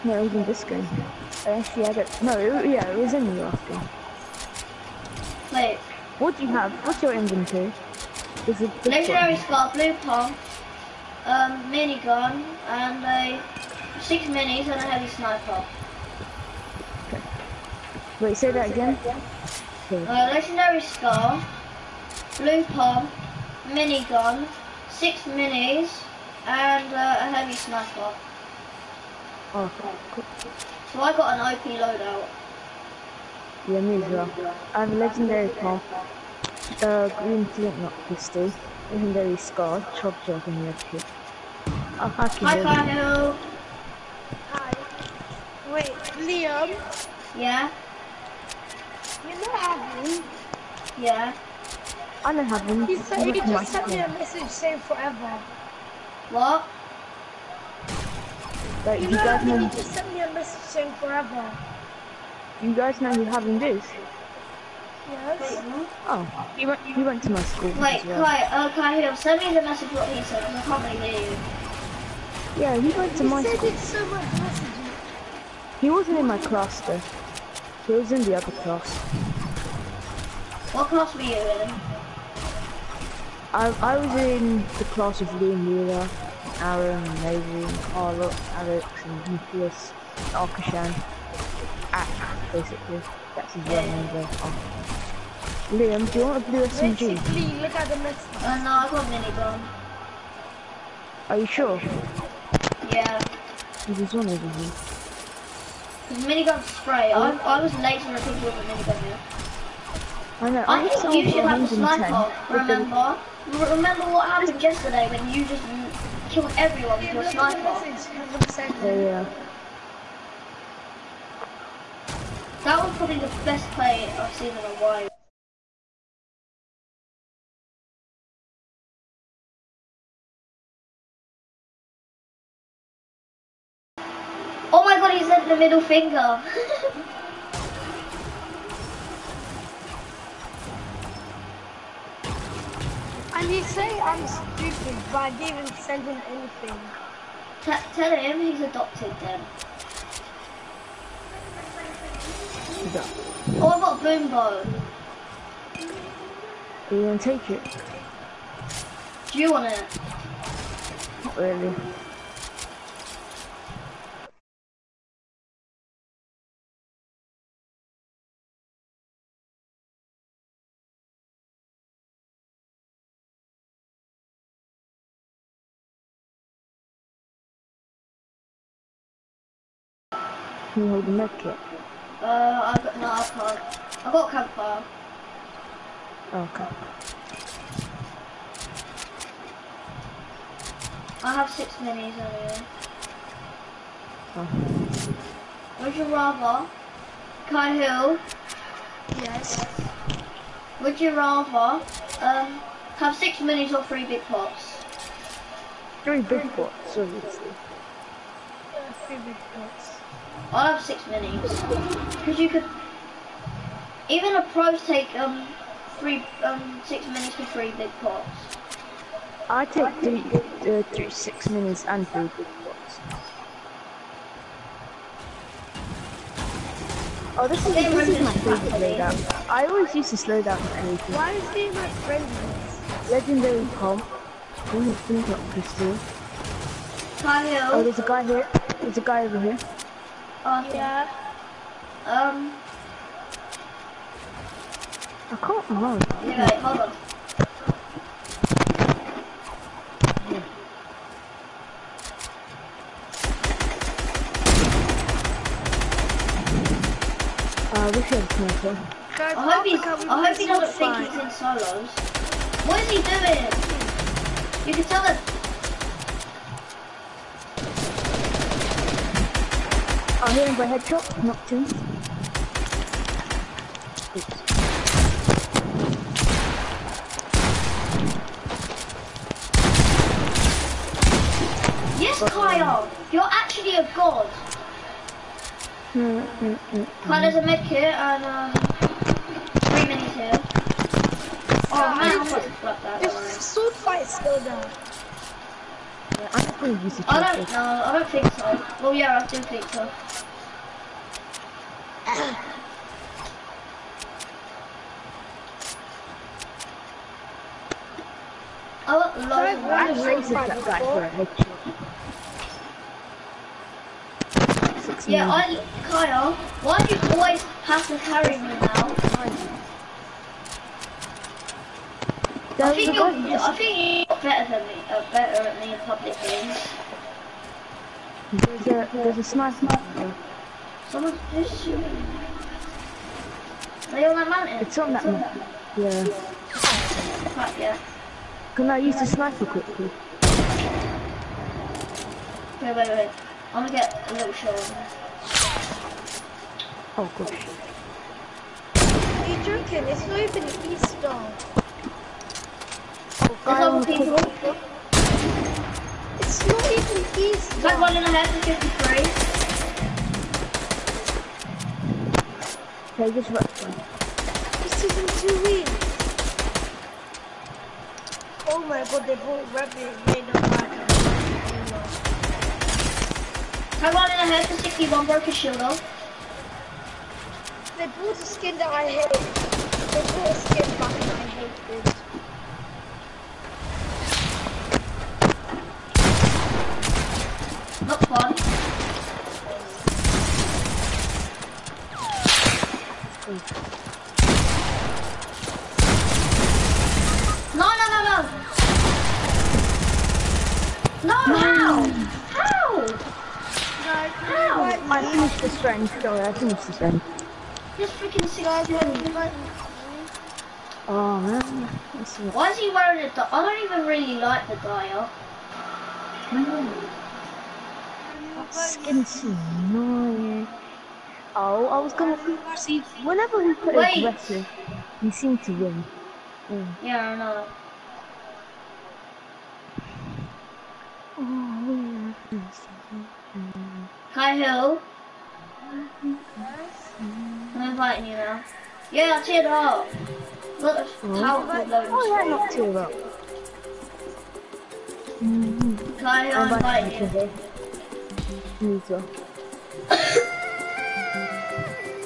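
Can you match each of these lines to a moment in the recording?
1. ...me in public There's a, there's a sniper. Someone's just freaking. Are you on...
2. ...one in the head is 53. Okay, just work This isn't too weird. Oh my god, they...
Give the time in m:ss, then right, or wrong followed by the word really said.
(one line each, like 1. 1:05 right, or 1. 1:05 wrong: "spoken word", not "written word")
1. 5:25 wrong: "shooting", not "freaking"
2. 5:57 right.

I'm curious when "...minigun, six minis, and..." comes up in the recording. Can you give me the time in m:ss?
0:23.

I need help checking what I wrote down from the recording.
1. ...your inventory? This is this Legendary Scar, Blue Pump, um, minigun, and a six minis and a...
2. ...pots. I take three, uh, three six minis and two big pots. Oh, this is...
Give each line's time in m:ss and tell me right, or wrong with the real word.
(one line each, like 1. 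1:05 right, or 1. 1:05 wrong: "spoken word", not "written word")
1. 0:07 right
2. 3:37 wrong: "three", not "two".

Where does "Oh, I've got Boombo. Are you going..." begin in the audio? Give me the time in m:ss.
2:33.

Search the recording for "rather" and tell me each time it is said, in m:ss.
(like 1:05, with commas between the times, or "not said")
3:16, 3:21.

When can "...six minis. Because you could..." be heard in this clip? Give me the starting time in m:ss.
3:30.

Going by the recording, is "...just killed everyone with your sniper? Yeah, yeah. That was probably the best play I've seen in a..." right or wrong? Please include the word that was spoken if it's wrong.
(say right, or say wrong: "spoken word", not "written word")
right.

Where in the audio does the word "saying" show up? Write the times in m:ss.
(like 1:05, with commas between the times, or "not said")
0:54, 1:00.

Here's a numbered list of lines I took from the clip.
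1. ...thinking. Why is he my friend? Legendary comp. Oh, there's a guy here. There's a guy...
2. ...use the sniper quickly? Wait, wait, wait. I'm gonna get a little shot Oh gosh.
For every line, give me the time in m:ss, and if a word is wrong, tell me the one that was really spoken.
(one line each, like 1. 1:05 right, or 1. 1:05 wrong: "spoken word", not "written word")
1. 3:50 wrong: "anything", not "thinking"
2. 5:38 right.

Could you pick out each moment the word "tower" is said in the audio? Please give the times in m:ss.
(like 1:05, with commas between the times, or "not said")
7:21.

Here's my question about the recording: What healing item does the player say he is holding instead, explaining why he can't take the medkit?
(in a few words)
campfire.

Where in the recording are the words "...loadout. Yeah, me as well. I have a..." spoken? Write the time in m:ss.
0:31.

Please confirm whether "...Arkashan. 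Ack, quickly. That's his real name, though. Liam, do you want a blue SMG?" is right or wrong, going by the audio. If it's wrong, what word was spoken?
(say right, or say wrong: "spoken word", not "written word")
wrong: "basically", not "quickly".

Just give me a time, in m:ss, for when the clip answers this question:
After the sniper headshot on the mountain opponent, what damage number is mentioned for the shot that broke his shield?
6:14.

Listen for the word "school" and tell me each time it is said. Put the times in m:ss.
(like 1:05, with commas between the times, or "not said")
1:07, 1:13.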